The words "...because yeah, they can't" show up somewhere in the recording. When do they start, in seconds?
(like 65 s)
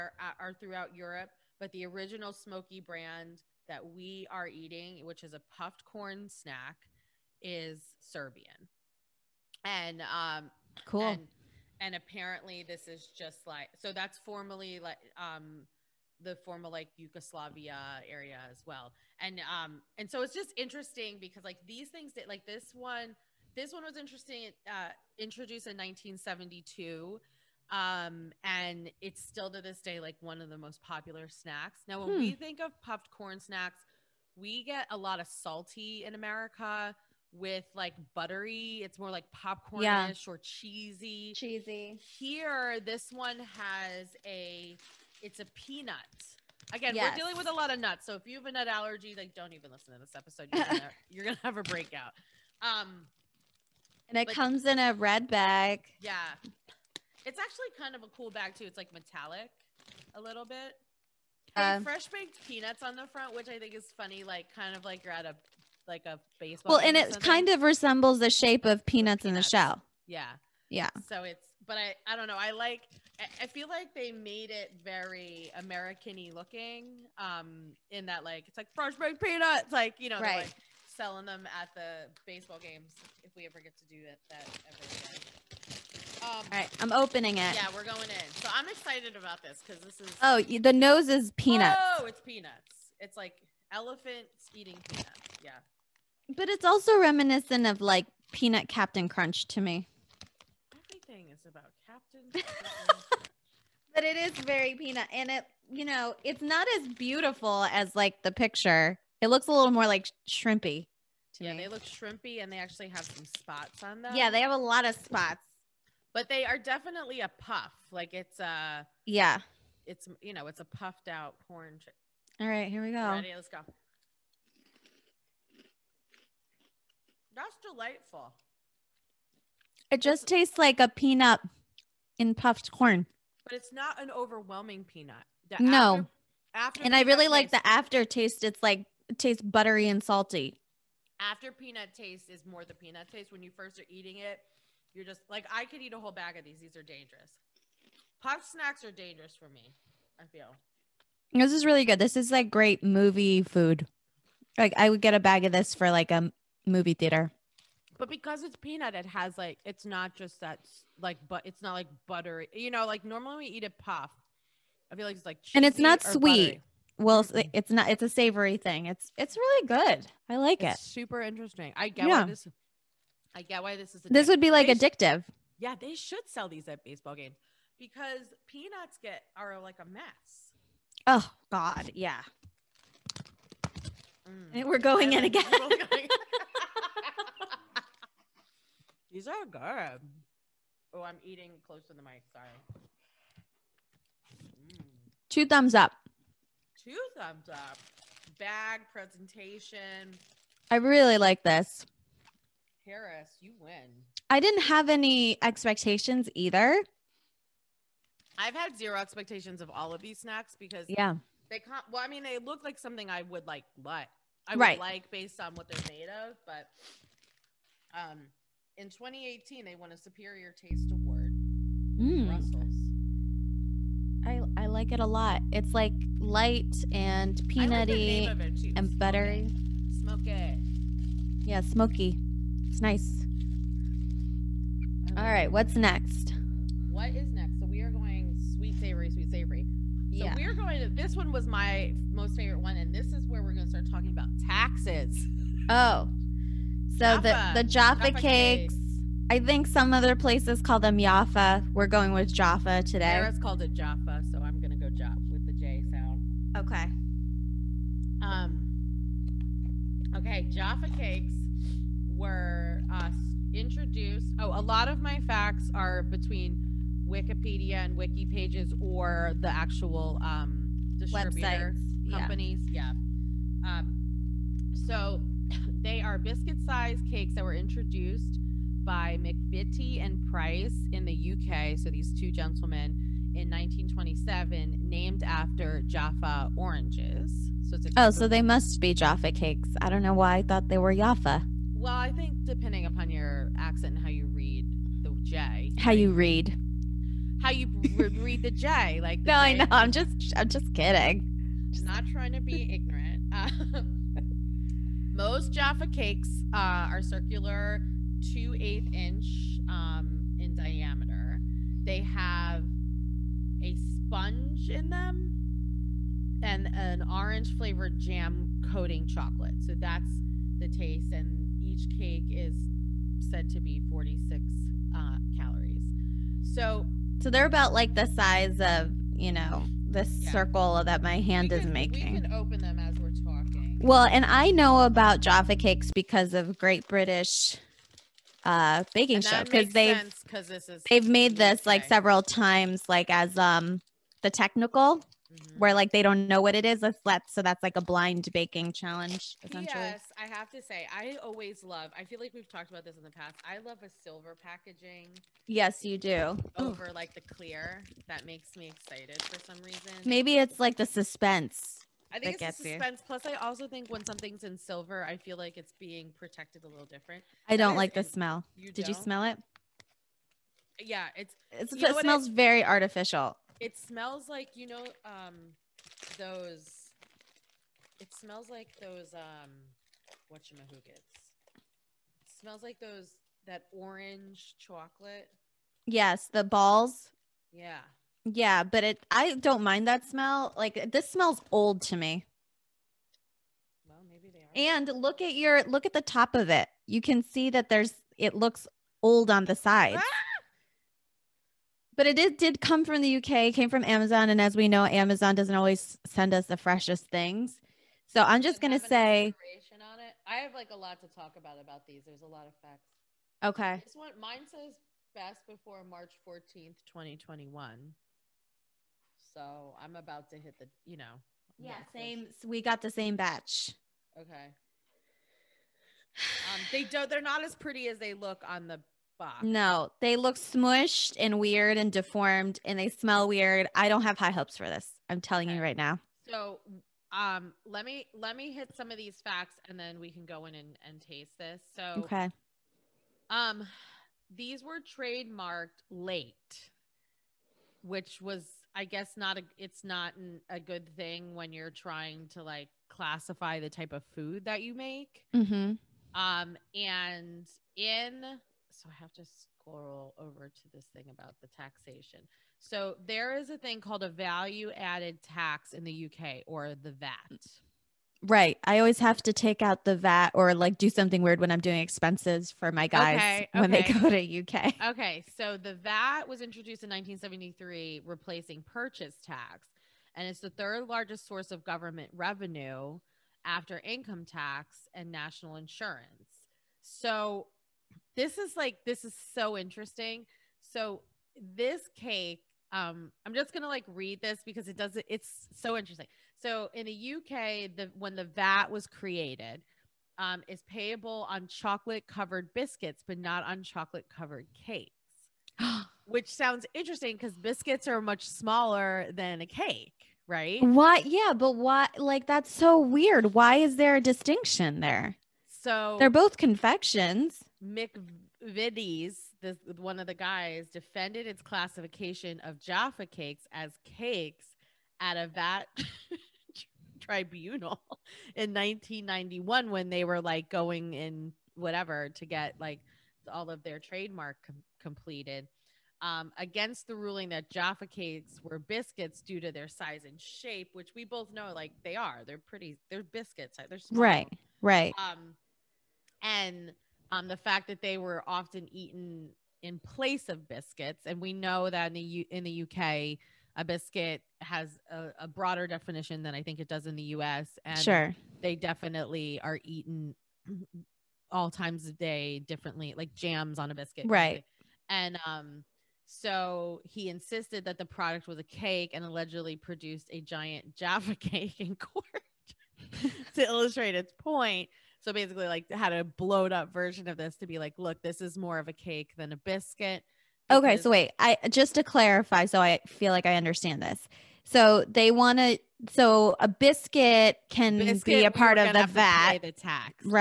210 s.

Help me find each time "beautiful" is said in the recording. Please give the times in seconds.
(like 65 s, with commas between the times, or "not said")
106 s.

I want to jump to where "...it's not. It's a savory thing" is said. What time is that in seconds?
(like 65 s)
167 s.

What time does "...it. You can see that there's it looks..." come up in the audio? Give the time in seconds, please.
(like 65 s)
396 s.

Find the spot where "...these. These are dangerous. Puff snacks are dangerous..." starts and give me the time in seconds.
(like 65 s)
146 s.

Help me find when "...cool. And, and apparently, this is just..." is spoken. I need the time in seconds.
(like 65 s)
10 s.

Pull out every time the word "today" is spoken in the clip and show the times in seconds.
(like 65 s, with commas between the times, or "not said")
252 s.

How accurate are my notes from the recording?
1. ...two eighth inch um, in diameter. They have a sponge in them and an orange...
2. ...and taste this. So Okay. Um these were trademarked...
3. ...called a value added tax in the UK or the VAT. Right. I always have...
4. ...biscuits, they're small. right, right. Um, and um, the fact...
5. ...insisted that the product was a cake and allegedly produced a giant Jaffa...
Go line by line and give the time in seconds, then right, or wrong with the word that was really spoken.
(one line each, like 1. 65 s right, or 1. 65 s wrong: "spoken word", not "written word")
1. 308 s right
2. 440 s right
3. 463 s right
4. 543 s right
5. 567 s right.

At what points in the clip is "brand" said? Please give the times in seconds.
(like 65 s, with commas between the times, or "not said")
2 s.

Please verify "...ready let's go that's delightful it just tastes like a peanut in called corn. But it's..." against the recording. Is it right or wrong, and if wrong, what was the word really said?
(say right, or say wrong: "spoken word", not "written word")
wrong: "puffed", not "called".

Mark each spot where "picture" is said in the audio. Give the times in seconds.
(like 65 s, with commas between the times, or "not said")
108 s.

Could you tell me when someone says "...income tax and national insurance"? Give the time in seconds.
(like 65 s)
483 s.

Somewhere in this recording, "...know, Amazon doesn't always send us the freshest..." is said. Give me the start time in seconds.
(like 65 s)
404 s.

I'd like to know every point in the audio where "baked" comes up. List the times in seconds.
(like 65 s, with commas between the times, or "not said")
62 s, 78 s.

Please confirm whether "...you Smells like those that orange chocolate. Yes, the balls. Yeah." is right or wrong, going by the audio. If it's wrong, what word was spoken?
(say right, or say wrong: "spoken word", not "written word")
right.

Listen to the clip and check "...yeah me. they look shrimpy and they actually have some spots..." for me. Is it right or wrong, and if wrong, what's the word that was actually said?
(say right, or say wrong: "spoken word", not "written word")
right.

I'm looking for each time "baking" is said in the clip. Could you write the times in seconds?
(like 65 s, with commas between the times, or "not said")
338 s, 348 s.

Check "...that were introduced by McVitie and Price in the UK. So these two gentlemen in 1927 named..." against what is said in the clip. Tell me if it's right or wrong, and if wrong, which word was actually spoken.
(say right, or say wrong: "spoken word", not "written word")
right.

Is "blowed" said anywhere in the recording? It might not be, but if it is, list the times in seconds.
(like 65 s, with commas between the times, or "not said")
576 s.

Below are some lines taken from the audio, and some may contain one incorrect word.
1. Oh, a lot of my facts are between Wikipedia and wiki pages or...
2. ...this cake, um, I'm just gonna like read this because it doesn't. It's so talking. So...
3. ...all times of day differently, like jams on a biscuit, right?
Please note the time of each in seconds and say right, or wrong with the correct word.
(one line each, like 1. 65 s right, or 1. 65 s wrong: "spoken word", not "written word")
1. 264 s right
2. 491 s wrong: "interesting", not "talking"
3. 561 s right.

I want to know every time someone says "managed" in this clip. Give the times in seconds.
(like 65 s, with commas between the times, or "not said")
not said.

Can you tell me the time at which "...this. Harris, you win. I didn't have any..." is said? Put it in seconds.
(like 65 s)
201 s.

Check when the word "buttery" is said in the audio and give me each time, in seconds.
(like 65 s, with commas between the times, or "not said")
38 s, 139 s, 162 s, 166 s, 228 s.